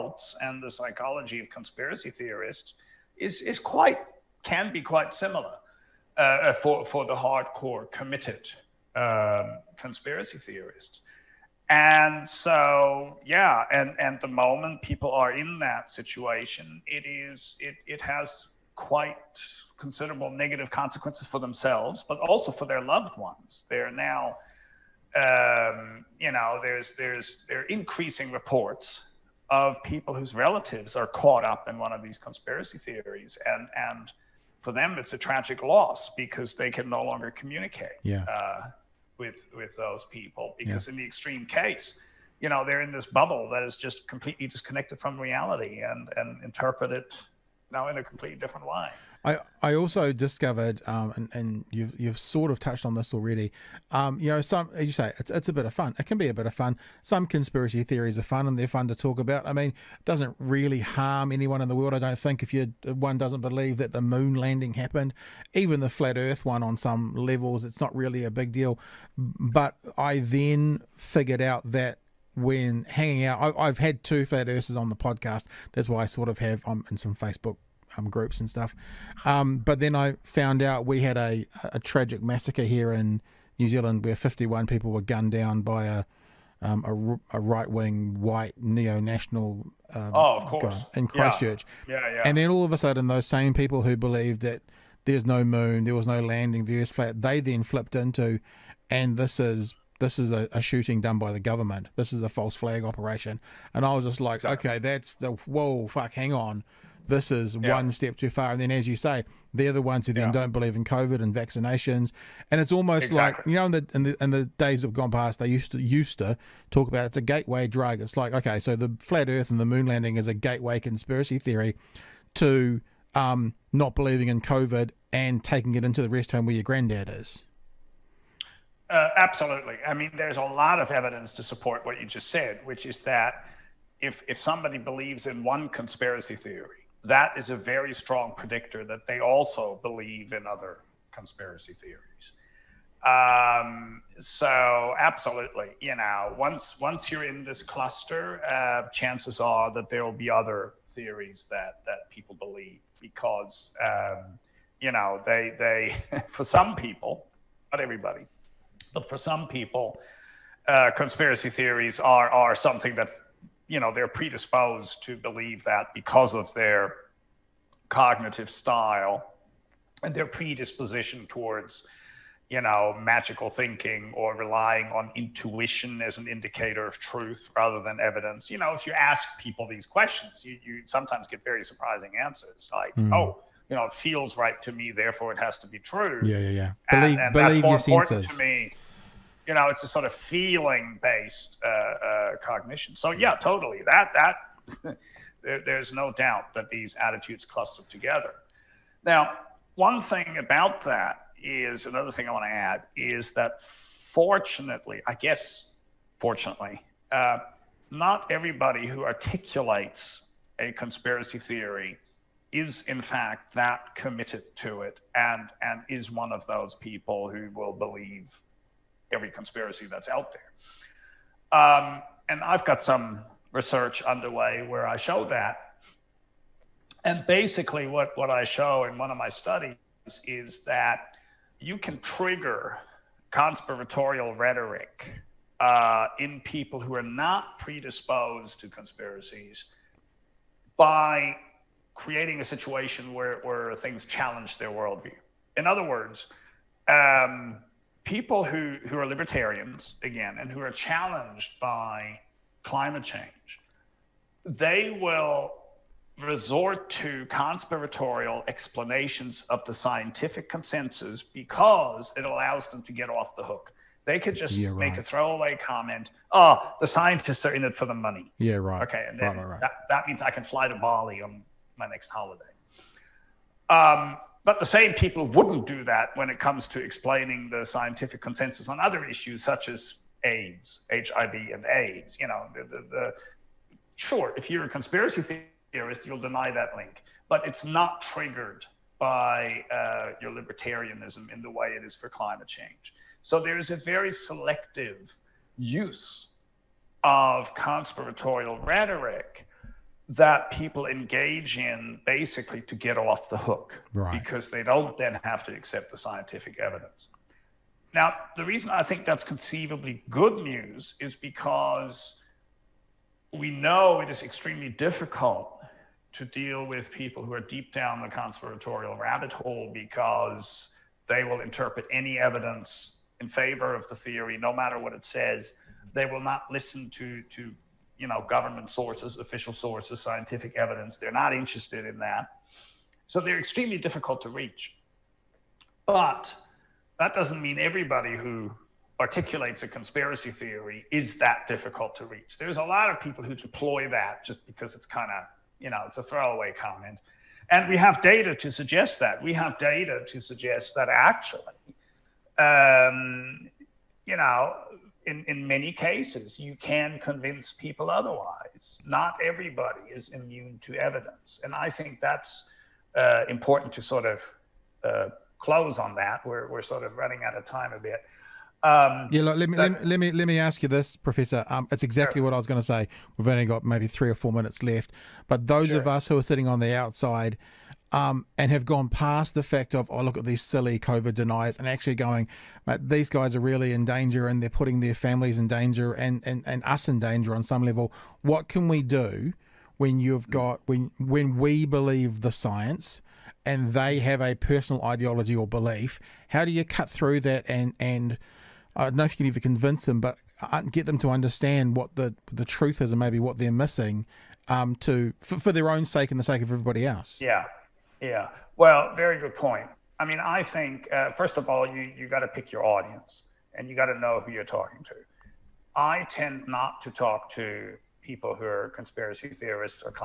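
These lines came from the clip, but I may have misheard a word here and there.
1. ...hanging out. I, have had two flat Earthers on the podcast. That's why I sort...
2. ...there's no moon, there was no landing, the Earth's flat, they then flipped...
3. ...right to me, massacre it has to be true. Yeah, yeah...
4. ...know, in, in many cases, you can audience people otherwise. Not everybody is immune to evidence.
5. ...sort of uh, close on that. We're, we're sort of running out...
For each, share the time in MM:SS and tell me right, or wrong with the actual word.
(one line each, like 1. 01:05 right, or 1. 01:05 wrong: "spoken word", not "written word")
1. 01:12 right
2. 01:35 right
3. 03:04 wrong: "therefore", not "massacre"
4. 05:54 wrong: "convince", not "audience"
5. 06:03 right.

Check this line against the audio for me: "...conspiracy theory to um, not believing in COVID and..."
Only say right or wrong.
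right.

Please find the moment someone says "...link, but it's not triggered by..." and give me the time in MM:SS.
04:46.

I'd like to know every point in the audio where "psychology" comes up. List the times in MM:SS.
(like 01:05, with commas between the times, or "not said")
00:00.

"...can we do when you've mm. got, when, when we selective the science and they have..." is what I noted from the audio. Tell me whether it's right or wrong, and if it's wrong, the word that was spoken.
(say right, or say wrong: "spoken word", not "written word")
wrong: "believe", not "selective".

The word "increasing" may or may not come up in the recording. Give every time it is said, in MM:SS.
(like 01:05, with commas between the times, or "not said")
00:27.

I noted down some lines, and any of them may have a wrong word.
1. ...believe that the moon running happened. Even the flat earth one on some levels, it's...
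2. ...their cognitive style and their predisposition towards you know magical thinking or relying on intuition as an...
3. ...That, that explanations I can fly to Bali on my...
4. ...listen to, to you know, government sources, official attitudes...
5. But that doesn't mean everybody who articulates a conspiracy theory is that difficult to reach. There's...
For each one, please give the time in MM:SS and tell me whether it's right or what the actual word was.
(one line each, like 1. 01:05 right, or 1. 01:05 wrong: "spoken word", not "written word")
1. 01:03 wrong: "landing", not "running"
2. 02:46 right
3. 04:29 wrong: "means", not "explanations"
4. 05:26 wrong: "sources", not "attitudes"
5. 05:35 right.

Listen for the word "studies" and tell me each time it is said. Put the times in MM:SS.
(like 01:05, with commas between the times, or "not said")
03:49.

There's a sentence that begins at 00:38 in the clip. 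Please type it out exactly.
uh, with with those people because yeah.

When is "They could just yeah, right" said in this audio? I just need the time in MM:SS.
04:24.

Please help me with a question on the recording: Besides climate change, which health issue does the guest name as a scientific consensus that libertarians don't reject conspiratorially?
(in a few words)
HIV and AIDS.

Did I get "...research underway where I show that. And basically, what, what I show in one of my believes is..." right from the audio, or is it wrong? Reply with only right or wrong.
wrong.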